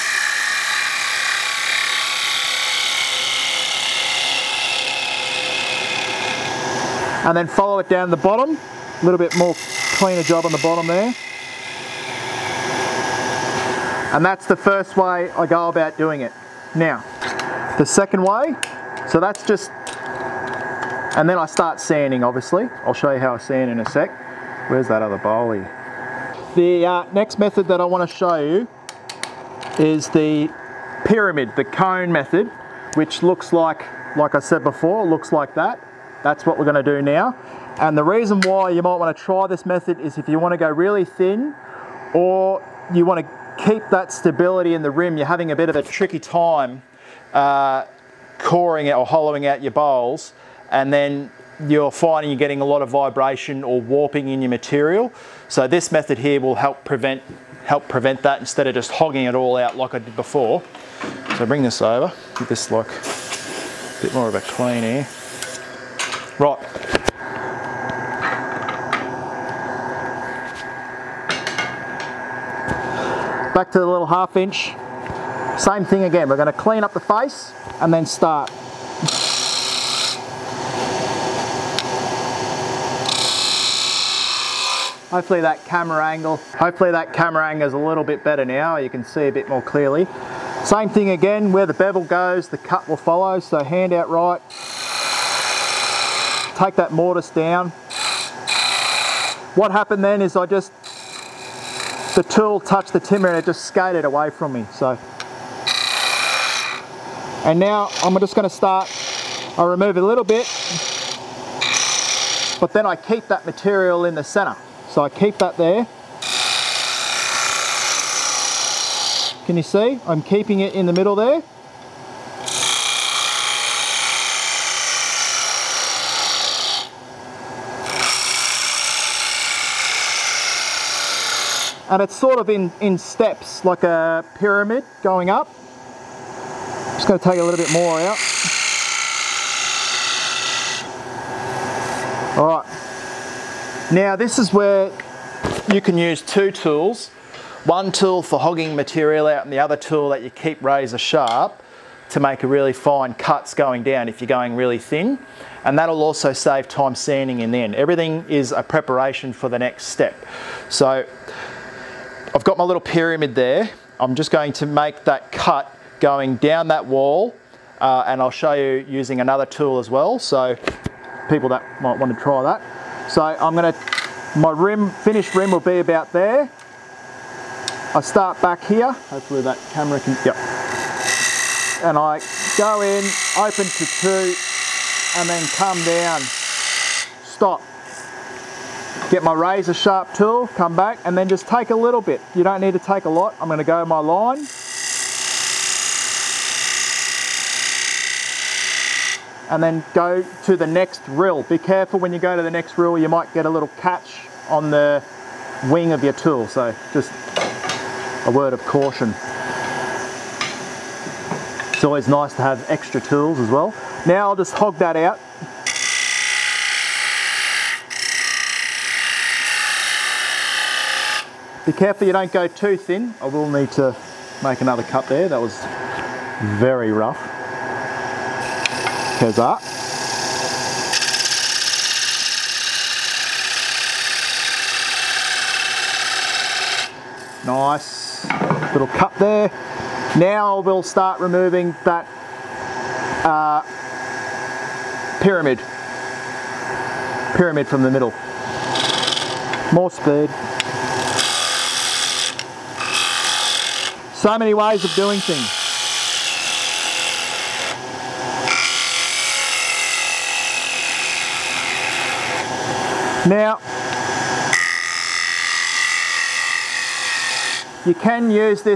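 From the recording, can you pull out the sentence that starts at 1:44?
So and now I'm just gonna start, I remove a little bit, but then I keep that material in the center.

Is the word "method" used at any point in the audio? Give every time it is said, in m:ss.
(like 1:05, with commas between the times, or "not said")
0:27, 0:32, 0:39, 0:55.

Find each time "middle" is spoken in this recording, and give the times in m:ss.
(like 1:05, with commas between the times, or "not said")
2:00, 4:07.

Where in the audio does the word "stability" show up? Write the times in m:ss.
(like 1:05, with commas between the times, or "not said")
0:44.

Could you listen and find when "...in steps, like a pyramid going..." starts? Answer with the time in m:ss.
2:12.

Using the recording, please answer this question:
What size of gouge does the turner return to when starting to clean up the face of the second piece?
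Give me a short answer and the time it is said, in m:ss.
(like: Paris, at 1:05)
half inch, at 1:14.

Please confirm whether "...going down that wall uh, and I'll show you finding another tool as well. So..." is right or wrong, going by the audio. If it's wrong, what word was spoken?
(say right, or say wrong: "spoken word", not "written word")
wrong: "using", not "finding".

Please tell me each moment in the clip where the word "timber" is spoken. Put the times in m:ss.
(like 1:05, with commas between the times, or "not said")
1:42.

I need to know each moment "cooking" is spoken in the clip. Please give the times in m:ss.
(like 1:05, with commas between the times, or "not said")
not said.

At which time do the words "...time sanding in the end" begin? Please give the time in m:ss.
2:36.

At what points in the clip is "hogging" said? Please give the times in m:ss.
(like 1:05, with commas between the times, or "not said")
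0:58, 2:28.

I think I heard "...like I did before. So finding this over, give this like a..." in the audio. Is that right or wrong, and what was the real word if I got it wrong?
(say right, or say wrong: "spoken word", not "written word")
wrong: "bring", not "finding".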